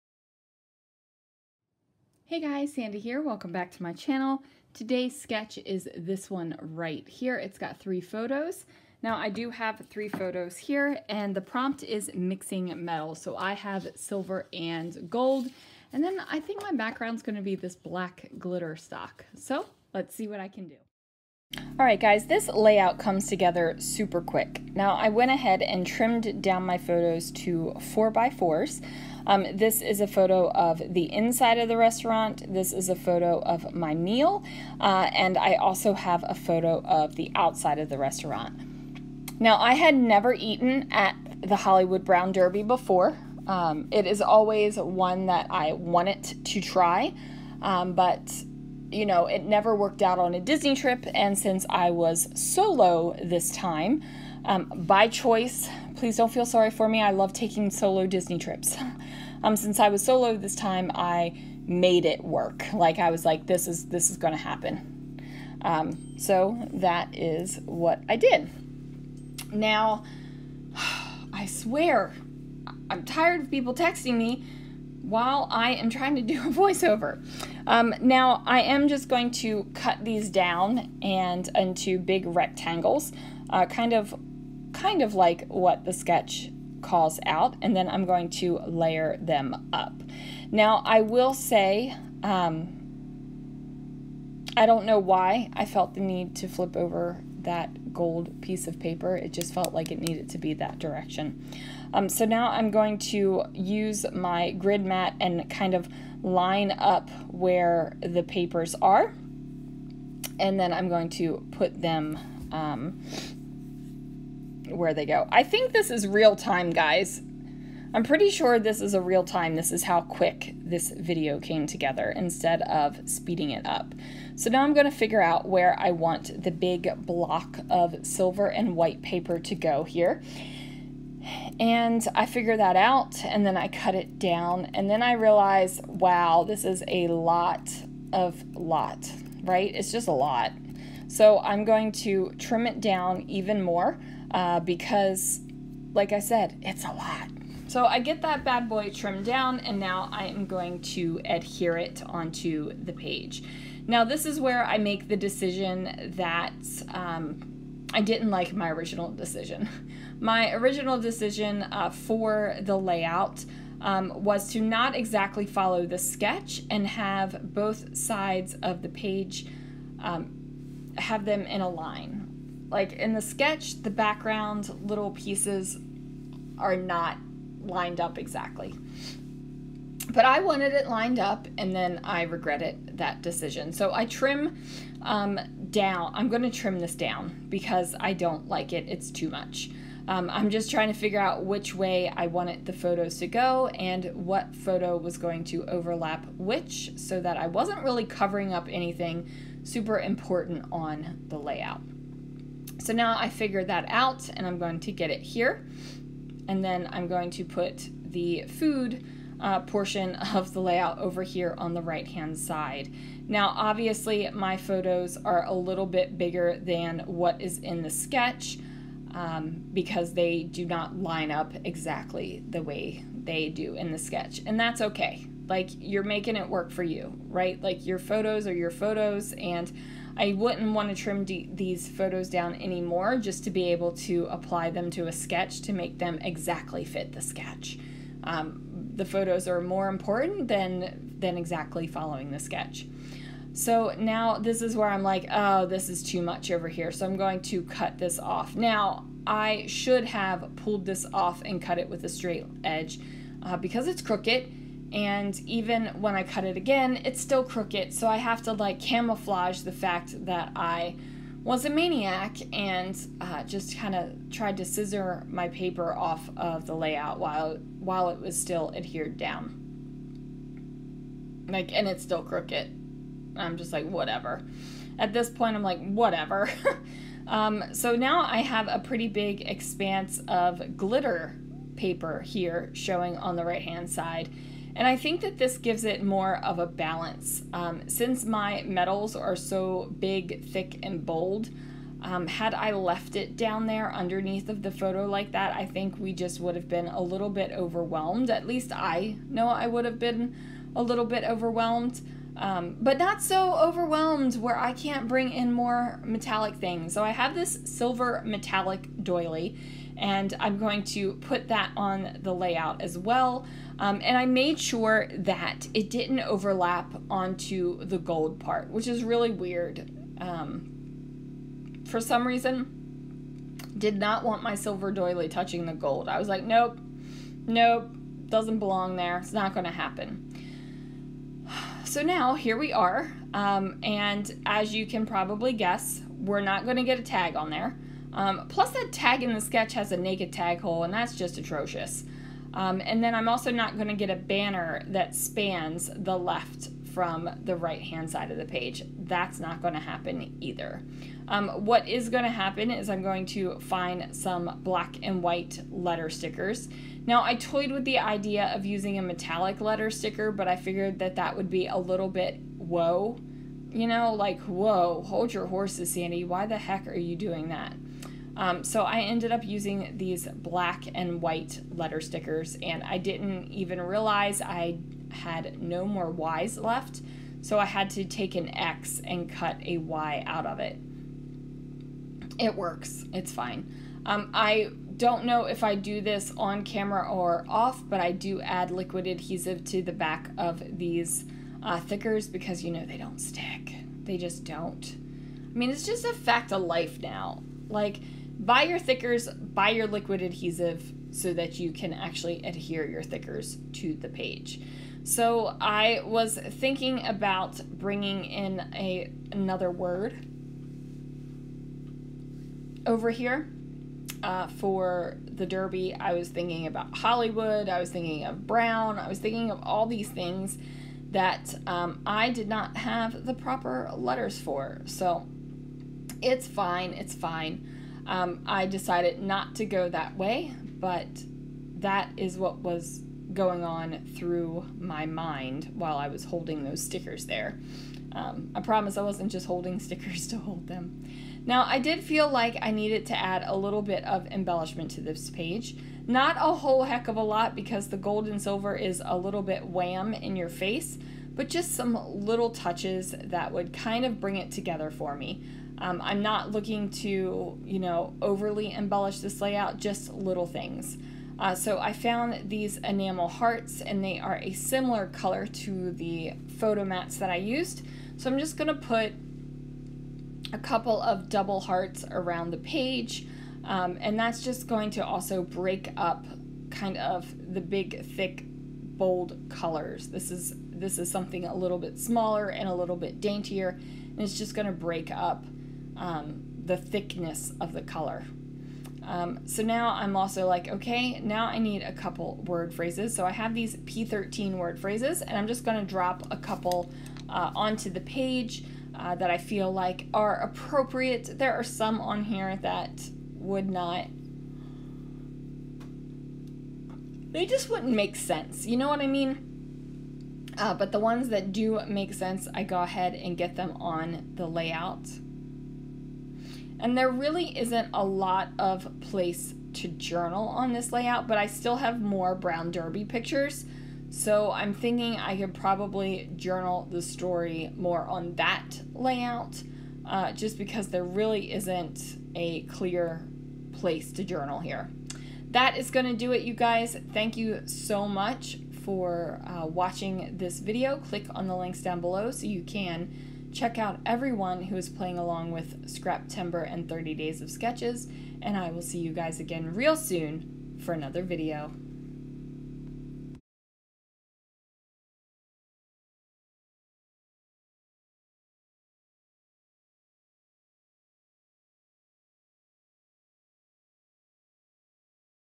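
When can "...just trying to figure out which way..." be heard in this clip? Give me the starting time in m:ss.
3:10.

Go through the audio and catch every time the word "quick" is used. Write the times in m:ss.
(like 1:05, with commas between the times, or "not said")
0:24, 2:00.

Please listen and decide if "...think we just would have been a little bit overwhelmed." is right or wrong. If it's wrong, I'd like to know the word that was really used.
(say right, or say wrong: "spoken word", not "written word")
right.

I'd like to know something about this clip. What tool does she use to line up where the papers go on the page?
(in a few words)
grid mat.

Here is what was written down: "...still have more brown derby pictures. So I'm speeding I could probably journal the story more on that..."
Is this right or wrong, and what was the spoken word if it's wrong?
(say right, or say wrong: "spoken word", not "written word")
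wrong: "thinking", not "speeding".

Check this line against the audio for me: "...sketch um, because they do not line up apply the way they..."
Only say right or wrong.
wrong.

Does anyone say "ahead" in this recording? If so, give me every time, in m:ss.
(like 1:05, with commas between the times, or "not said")
0:25, 8:32.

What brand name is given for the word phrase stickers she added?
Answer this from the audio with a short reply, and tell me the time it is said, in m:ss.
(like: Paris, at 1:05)
P13, at 8:13.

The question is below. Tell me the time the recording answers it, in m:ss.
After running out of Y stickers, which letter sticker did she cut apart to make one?
6:18.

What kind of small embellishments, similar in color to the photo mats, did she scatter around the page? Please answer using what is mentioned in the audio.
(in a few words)
enamel hearts.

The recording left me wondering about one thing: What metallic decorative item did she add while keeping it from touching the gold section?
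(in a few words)
silver metallic doily.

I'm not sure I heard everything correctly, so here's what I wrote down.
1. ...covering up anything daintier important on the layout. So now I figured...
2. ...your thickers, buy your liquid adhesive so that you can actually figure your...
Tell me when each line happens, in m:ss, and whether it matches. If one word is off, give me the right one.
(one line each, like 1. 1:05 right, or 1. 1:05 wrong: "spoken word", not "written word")
1. 3:18 wrong: "super", not "daintier"
2. 6:38 wrong: "adhere", not "figure".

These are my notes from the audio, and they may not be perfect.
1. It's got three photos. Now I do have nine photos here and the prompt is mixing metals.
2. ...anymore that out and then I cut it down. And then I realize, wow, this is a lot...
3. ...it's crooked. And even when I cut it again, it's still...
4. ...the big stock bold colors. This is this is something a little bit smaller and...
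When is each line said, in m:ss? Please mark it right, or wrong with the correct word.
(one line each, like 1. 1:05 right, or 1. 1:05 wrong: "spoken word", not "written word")
1. 0:07 wrong: "three", not "nine"
2. 2:12 wrong: "figure", not "anymore"
3. 4:13 right
4. 7:57 wrong: "thick", not "stock".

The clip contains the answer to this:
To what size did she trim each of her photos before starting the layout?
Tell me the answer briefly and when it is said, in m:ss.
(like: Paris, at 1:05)
4 by 4, at 0:27.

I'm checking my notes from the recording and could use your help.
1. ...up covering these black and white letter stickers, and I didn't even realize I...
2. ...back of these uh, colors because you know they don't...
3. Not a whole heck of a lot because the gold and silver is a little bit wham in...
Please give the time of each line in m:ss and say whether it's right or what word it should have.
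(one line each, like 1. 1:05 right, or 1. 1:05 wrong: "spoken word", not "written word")
1. 6:09 wrong: "using", not "covering"
2. 6:29 wrong: "thickers", not "colors"
3. 7:26 right.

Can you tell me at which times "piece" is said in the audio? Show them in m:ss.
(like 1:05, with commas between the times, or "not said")
1:38, 2:55.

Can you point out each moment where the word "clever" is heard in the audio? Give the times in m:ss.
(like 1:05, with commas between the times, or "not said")
not said.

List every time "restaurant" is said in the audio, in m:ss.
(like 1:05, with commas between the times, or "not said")
0:31, 0:37.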